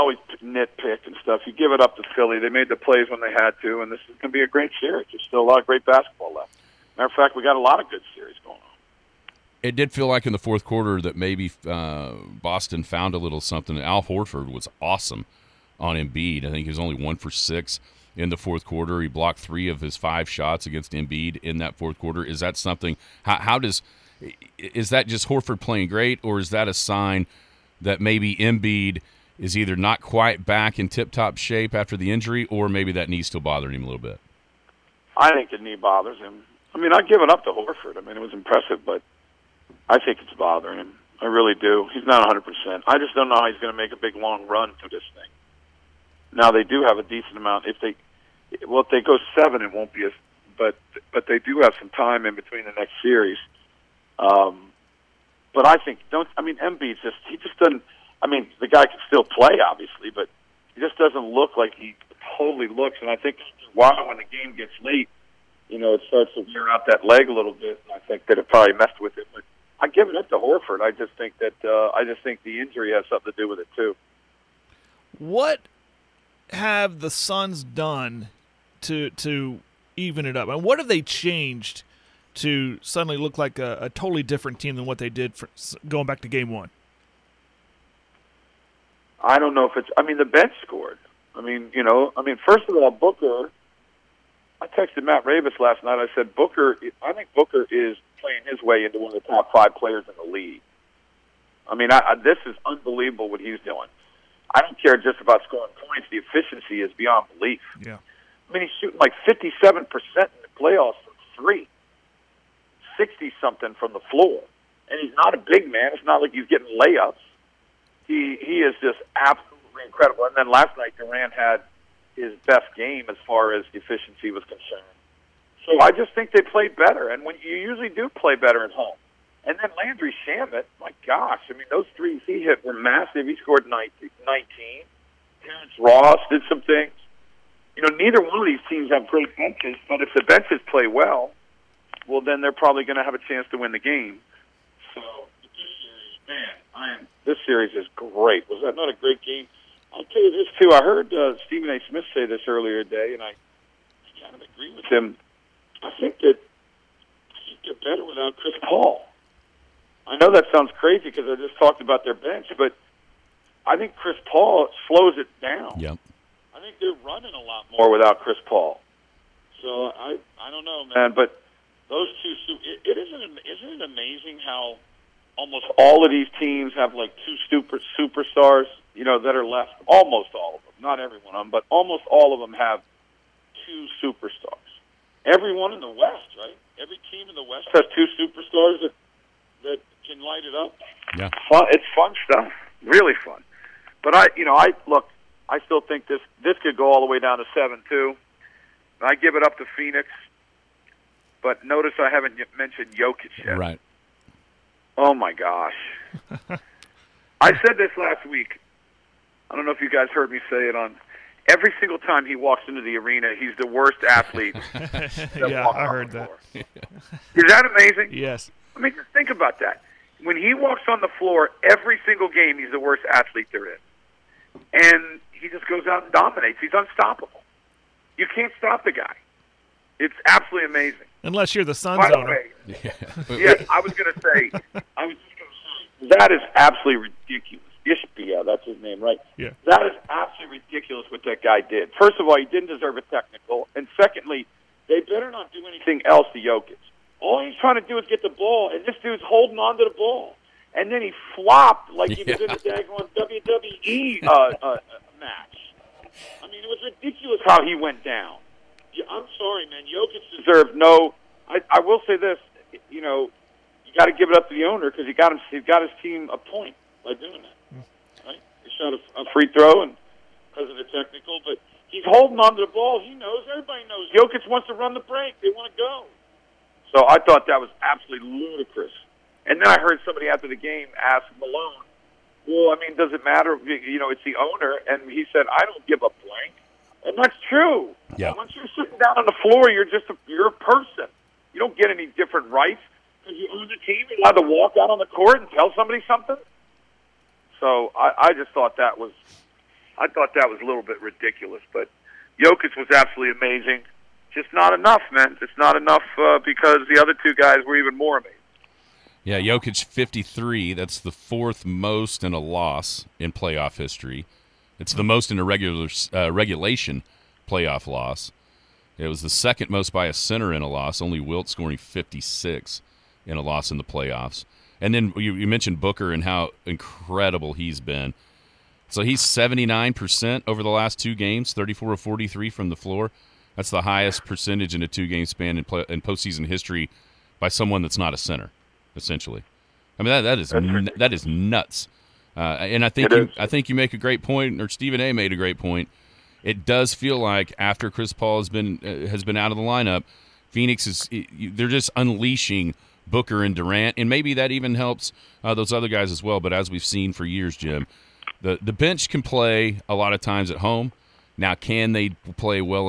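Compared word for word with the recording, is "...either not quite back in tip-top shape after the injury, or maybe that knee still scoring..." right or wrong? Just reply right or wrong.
wrong.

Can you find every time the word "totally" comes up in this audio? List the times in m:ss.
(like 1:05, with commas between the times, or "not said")
1:02, 1:23.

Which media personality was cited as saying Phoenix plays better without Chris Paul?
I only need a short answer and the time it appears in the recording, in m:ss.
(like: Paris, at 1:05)
Stephen A. Smith, at 2:31.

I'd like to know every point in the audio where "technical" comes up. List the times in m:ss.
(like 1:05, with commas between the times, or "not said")
4:03, 4:30.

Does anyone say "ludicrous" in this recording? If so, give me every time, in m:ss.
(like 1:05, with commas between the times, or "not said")
4:38.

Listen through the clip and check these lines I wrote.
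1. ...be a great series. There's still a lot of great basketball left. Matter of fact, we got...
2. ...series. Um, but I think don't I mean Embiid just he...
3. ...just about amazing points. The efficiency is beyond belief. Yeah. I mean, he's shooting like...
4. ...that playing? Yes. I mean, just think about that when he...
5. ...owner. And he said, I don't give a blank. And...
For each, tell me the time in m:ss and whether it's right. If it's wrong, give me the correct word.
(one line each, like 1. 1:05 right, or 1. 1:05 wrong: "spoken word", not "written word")
1. 0:04 right
2. 0:53 right
3. 1:44 wrong: "scoring", not "amazing"
4. 3:37 wrong: "amazing", not "playing"
5. 4:44 right.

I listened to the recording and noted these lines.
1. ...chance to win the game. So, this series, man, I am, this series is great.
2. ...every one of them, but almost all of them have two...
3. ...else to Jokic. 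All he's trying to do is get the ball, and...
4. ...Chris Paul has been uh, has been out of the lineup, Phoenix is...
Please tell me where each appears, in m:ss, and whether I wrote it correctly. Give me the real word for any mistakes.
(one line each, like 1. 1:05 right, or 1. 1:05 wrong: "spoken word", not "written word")
1. 2:23 right
2. 3:00 right
3. 4:06 right
4. 5:47 right.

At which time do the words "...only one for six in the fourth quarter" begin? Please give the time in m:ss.
0:16.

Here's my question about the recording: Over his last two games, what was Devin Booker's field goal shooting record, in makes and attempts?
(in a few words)
34 of 43.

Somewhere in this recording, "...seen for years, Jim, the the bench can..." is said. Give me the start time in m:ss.
5:56.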